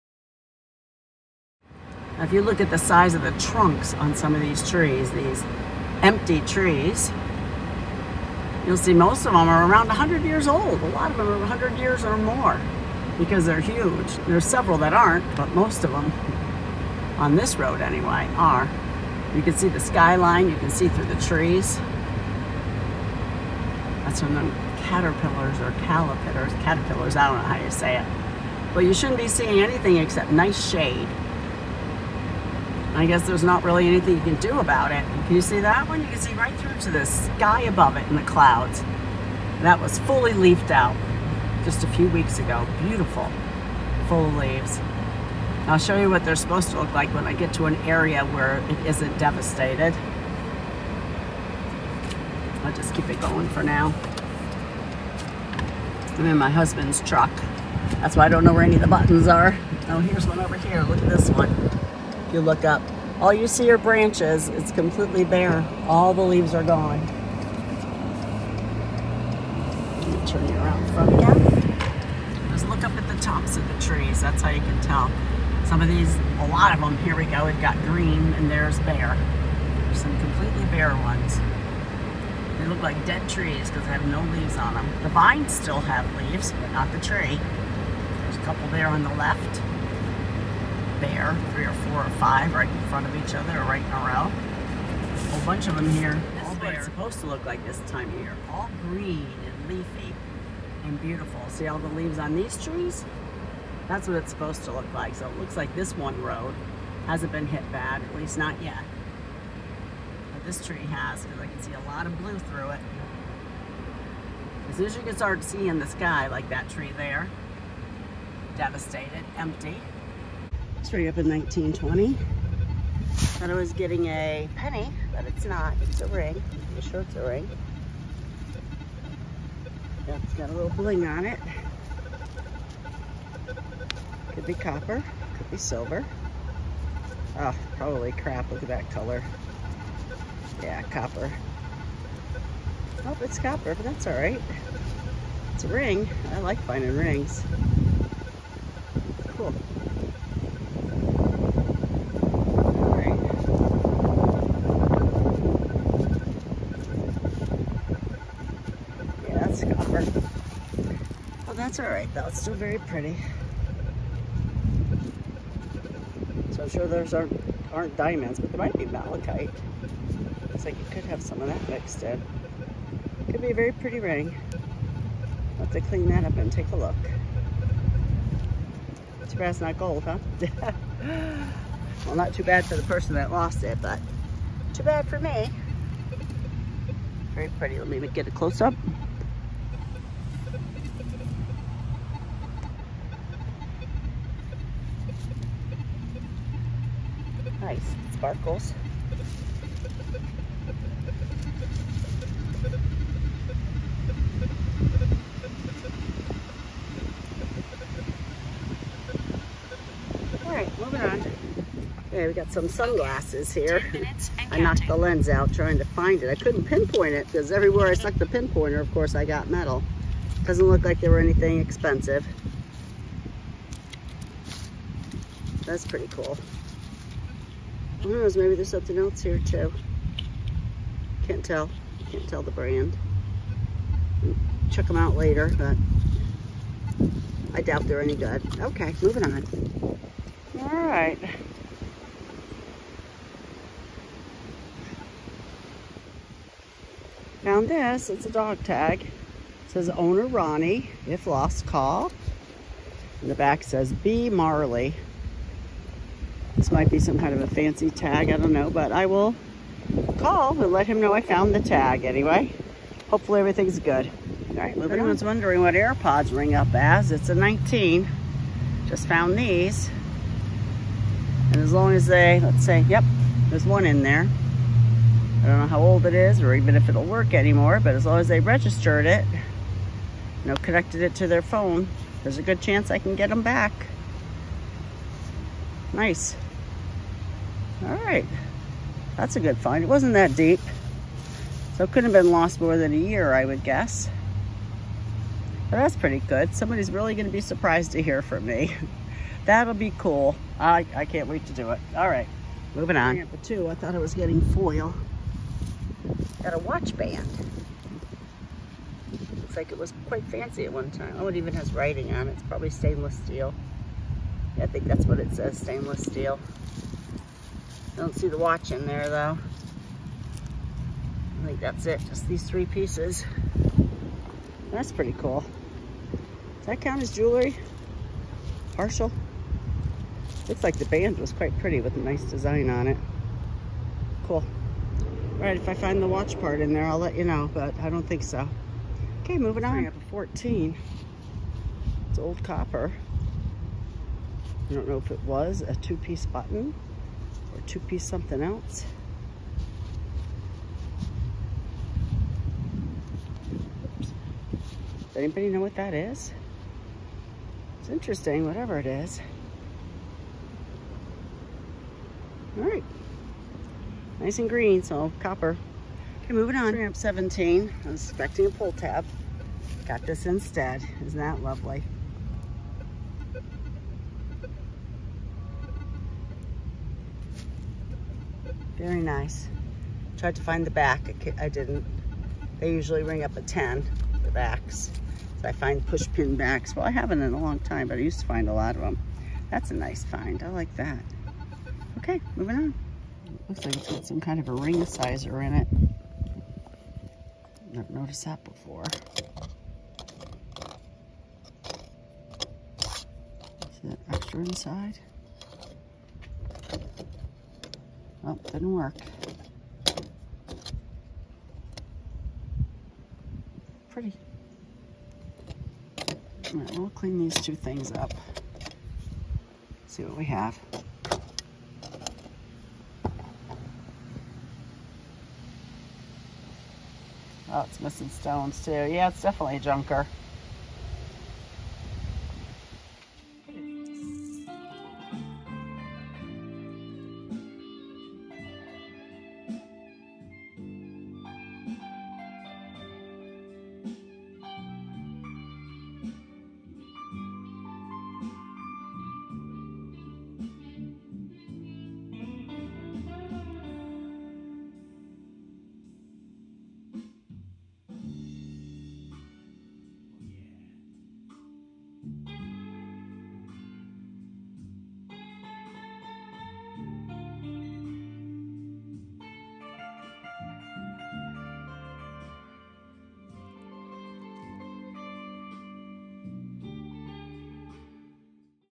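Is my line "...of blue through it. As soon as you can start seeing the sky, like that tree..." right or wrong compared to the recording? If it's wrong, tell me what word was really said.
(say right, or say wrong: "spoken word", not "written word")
right.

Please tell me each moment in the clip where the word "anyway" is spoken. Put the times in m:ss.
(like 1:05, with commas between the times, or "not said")
0:17, 4:22.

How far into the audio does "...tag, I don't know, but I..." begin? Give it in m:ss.
4:17.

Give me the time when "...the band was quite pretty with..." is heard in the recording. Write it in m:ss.
5:30.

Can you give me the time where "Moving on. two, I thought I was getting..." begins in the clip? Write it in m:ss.
5:02.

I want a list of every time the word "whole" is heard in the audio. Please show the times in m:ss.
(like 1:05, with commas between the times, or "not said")
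1:35.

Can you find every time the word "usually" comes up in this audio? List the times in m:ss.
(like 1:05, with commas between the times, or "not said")
6:22.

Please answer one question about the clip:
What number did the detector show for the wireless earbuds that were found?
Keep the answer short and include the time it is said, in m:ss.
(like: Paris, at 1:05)
19, at 4:27.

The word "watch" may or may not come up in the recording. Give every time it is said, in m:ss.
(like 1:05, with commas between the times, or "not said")
5:06, 5:18, 5:36.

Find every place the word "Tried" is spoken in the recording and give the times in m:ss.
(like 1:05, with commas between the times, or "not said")
6:20.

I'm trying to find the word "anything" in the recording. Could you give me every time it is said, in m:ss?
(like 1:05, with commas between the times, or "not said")
0:29, 0:33, 3:41.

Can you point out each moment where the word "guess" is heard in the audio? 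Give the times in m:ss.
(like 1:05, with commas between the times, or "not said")
0:33, 4:53.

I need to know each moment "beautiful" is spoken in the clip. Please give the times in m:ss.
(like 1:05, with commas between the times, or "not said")
0:42, 1:41.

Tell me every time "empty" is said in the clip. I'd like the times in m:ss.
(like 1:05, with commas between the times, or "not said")
0:06, 1:59.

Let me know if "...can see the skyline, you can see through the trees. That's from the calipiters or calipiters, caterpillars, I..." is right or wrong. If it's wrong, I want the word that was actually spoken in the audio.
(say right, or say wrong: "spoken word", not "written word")
wrong: "caterpillars", not "calipiters".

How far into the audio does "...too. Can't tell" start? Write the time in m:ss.
3:49.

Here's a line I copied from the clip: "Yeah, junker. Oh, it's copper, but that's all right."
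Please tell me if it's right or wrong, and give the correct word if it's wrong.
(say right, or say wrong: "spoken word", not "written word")
wrong: "copper", not "junker".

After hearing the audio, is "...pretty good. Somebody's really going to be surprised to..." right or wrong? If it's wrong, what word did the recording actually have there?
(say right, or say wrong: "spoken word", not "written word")
right.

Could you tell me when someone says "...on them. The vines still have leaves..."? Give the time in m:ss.
1:24.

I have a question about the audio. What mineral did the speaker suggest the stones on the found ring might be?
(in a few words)
Malachite.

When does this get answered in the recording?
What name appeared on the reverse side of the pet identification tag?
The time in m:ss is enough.
4:13.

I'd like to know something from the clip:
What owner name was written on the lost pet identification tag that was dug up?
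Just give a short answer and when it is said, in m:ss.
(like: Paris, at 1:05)
Ronnie, at 4:10.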